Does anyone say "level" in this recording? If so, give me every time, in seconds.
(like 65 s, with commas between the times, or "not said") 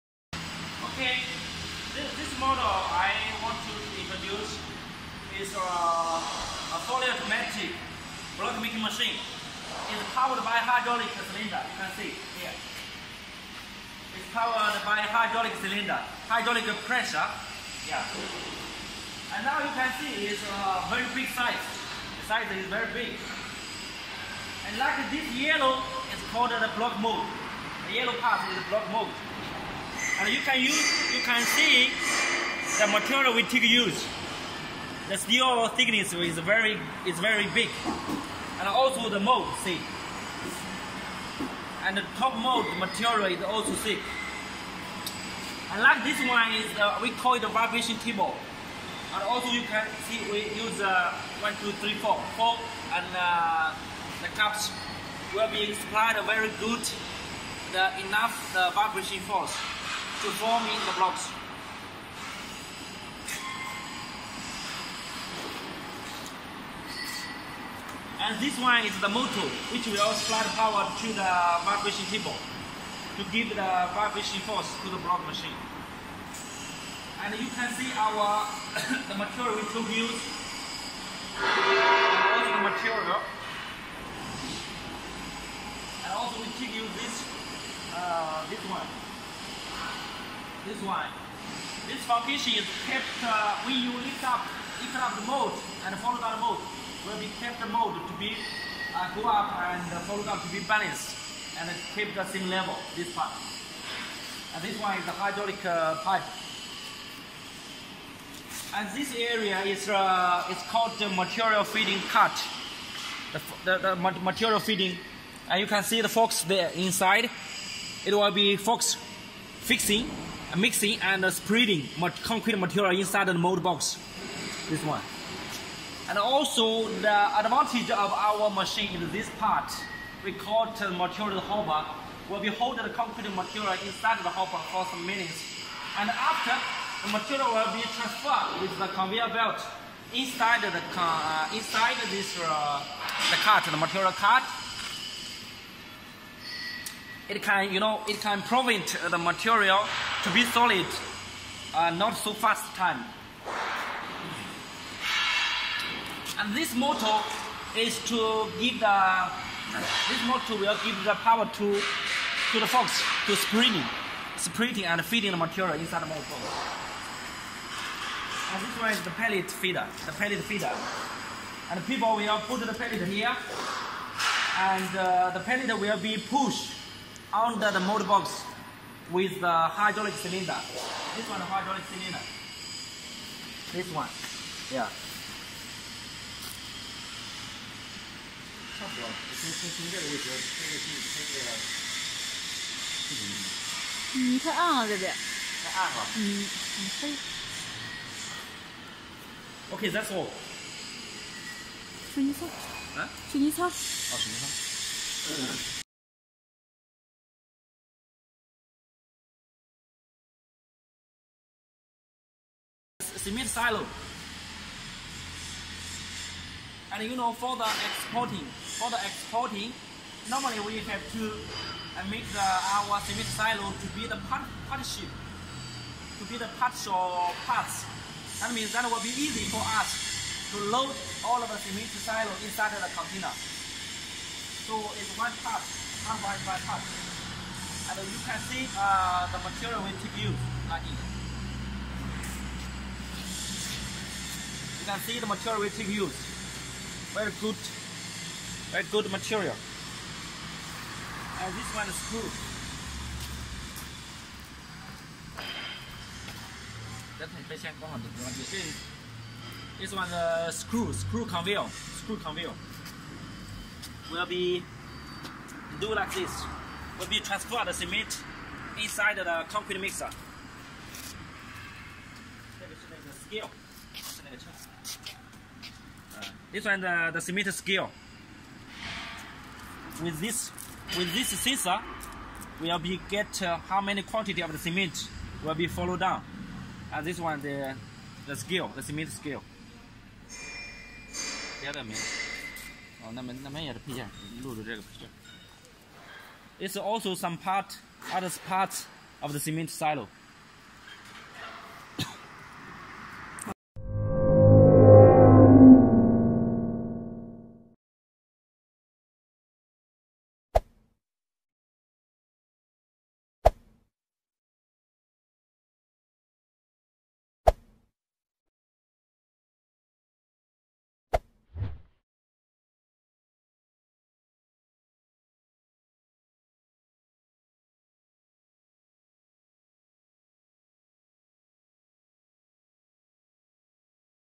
102 s.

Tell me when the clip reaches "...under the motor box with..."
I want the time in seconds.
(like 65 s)
177 s.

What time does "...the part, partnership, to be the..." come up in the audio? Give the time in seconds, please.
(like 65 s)
224 s.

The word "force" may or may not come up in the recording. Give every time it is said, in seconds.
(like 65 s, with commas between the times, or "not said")
59 s, 74 s.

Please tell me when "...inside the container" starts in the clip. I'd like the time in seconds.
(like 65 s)
232 s.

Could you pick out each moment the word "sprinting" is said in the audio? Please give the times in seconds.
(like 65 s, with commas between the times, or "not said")
164 s.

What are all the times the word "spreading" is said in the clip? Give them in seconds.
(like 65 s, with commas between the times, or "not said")
121 s.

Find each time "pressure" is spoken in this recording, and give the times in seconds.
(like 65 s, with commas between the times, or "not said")
16 s.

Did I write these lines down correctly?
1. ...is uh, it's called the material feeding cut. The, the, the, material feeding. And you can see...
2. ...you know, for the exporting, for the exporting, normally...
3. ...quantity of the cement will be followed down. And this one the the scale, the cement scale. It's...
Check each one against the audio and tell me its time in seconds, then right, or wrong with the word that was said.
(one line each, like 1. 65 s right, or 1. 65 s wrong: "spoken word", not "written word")
1. 109 s right
2. 217 s right
3. 284 s right.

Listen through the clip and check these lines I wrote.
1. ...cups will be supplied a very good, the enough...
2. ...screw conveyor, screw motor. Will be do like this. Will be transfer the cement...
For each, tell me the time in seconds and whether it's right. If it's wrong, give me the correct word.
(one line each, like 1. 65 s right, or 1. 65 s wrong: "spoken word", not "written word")
1. 54 s right
2. 260 s wrong: "conveyor", not "motor".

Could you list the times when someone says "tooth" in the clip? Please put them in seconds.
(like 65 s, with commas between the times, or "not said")
not said.